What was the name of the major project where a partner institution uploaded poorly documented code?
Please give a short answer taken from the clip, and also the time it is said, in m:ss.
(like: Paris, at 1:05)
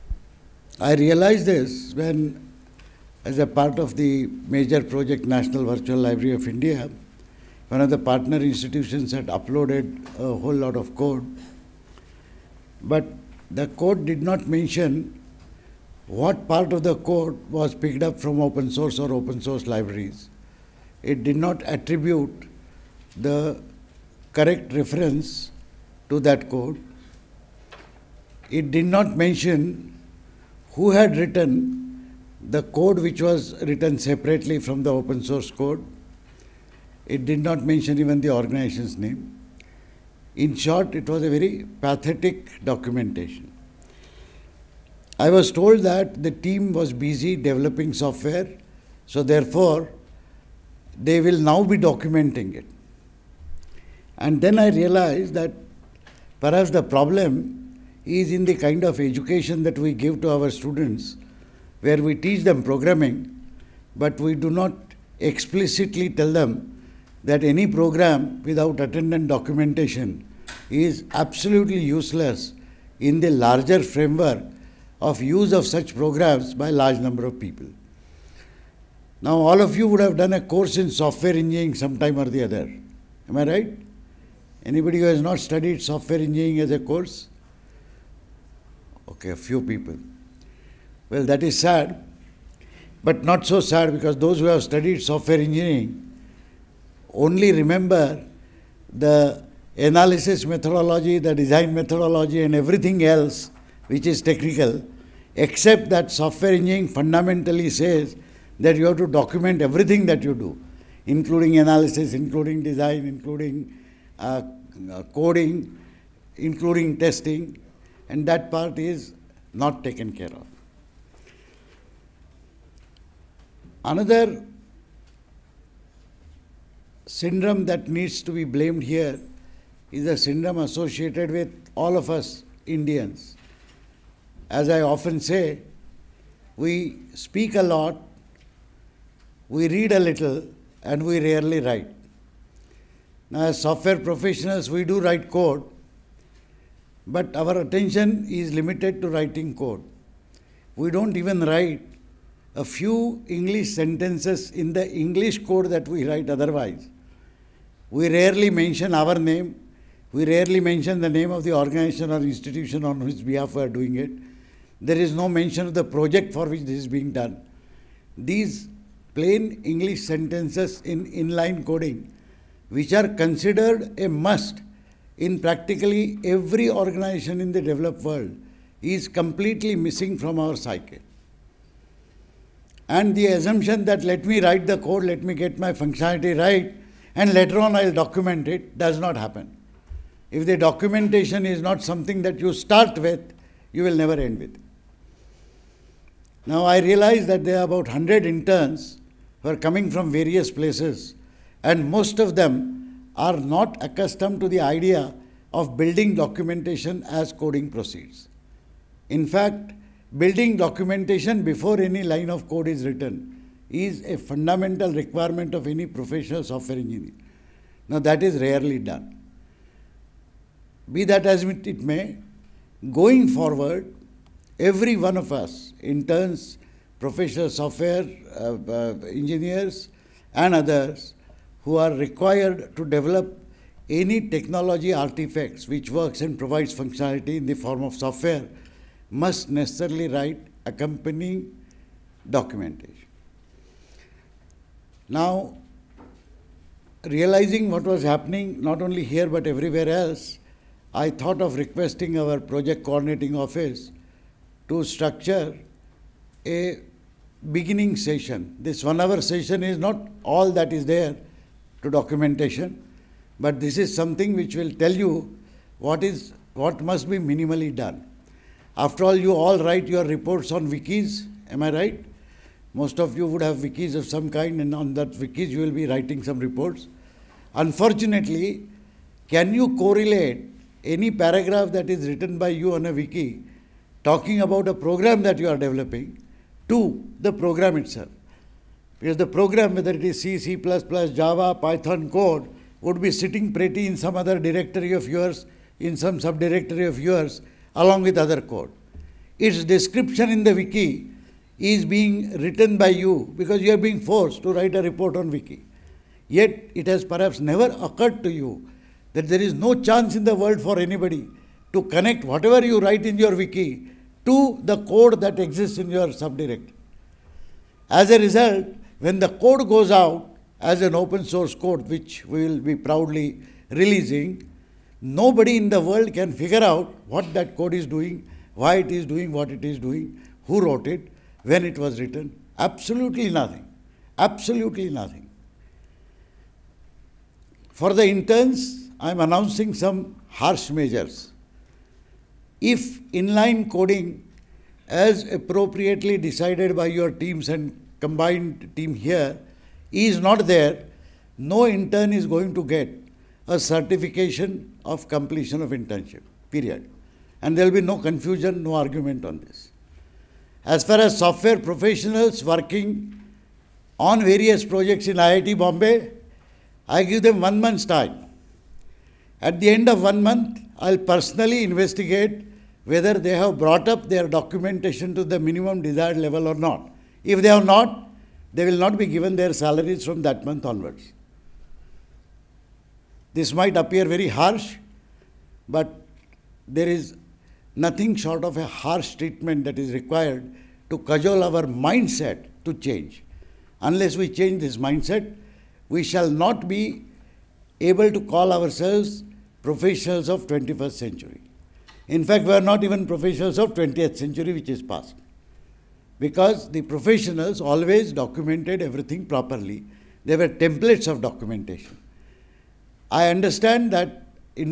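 National Virtual Library of India, at 0:05.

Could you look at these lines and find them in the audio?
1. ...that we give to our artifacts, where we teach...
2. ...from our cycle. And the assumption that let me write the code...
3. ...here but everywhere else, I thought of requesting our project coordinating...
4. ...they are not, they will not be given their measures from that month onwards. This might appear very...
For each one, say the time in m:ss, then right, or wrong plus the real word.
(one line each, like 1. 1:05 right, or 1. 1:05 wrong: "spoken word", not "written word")
1. 0:59 wrong: "students", not "artifacts"
2. 3:00 right
3. 4:09 right
4. 6:17 wrong: "salaries", not "measures".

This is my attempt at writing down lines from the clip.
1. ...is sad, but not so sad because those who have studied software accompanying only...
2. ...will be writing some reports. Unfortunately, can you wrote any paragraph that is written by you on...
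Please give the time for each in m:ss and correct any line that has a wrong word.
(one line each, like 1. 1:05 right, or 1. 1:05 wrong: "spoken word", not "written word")
1. 1:31 wrong: "engineering", not "accompanying"
2. 4:35 wrong: "correlate", not "wrote".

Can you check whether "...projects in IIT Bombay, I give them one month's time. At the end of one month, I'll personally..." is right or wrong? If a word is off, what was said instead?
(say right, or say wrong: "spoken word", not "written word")
right.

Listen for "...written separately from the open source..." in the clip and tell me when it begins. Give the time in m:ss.
0:33.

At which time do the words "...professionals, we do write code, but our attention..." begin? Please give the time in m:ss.
2:23.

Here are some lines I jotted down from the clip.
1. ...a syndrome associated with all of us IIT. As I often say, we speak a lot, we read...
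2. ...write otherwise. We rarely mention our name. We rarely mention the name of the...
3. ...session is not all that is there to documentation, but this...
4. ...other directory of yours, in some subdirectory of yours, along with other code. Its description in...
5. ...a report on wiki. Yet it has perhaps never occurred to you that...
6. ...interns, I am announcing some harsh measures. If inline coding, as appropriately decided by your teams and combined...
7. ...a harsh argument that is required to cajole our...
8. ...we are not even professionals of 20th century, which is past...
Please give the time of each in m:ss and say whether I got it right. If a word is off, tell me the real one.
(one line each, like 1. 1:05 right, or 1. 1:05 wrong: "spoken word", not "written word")
1. 2:10 wrong: "Indians", not "IIT"
2. 2:36 right
3. 4:19 right
4. 4:54 right
5. 5:04 right
6. 5:38 right
7. 6:28 wrong: "treatment", not "argument"
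8. 6:42 right.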